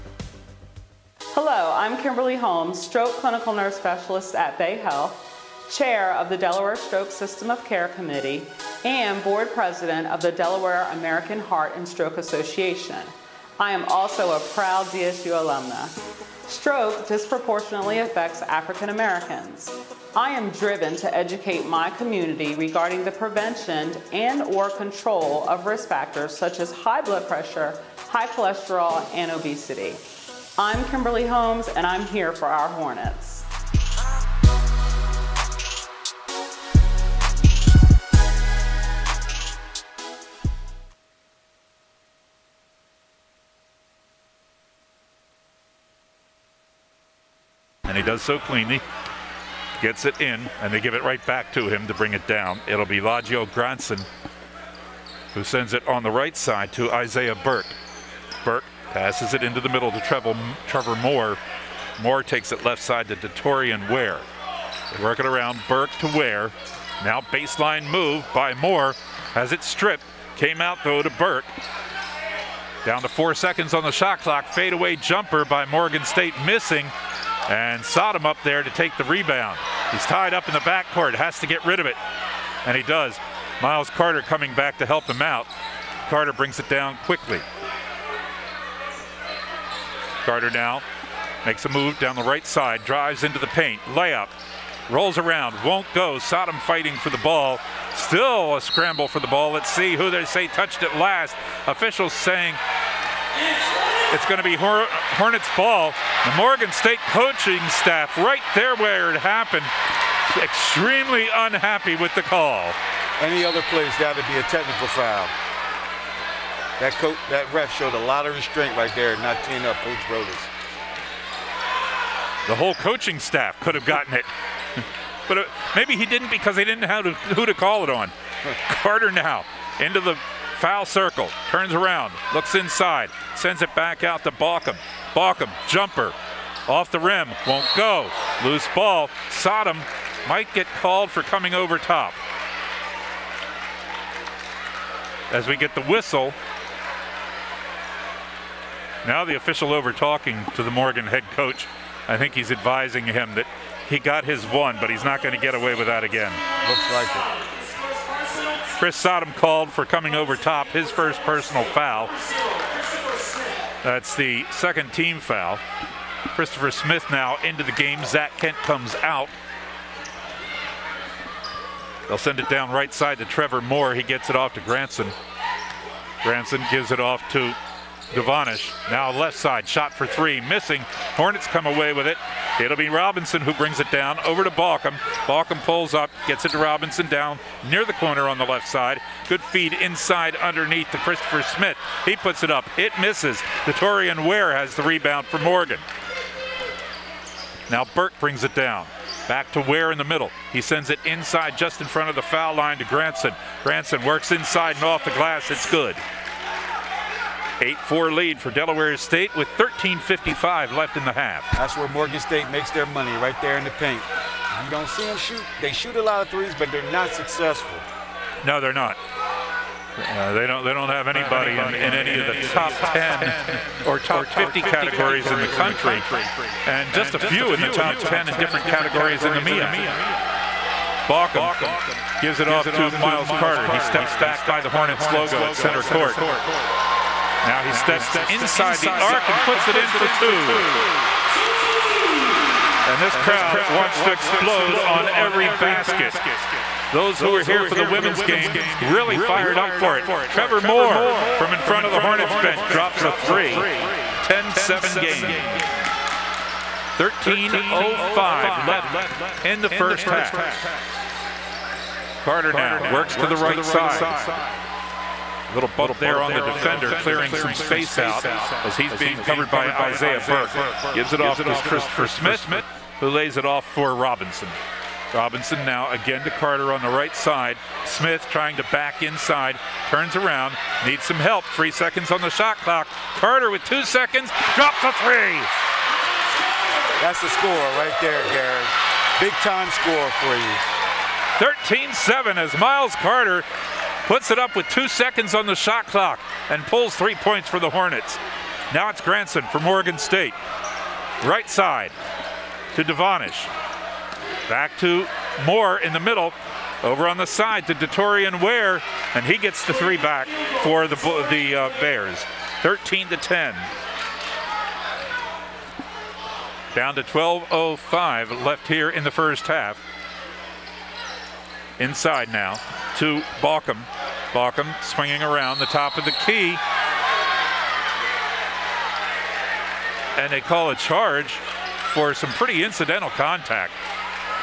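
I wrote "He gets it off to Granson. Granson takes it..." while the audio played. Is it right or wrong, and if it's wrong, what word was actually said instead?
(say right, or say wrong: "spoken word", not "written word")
wrong: "gives", not "takes".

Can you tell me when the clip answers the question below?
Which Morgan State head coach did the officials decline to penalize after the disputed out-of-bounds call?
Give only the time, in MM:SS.
01:59.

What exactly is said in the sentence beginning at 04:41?
Three seconds on the shot clock.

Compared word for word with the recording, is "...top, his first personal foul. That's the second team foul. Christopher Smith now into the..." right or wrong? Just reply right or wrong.
right.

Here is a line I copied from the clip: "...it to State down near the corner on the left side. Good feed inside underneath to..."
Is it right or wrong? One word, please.
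wrong.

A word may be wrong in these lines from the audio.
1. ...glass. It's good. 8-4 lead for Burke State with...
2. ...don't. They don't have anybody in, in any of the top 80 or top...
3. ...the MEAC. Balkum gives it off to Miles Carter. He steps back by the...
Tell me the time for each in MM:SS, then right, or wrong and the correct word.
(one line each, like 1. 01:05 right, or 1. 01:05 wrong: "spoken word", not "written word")
1. 03:25 wrong: "Delaware", not "Burke"
2. 03:40 wrong: "10", not "80"
3. 03:49 right.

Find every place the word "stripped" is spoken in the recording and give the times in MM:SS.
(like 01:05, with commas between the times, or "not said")
01:09.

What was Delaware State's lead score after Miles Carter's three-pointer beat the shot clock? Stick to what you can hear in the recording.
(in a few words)
13-7.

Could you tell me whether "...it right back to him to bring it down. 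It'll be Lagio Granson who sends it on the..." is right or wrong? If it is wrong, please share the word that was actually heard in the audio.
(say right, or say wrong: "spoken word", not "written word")
right.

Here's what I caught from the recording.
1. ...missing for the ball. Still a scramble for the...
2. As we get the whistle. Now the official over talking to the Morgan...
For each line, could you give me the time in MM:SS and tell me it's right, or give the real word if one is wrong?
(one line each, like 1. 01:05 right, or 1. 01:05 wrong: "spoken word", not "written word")
1. 01:36 wrong: "fighting", not "missing"
2. 02:25 right.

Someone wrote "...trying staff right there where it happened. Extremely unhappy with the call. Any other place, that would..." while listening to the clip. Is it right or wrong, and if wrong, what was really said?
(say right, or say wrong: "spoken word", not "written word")
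wrong: "coaching", not "trying".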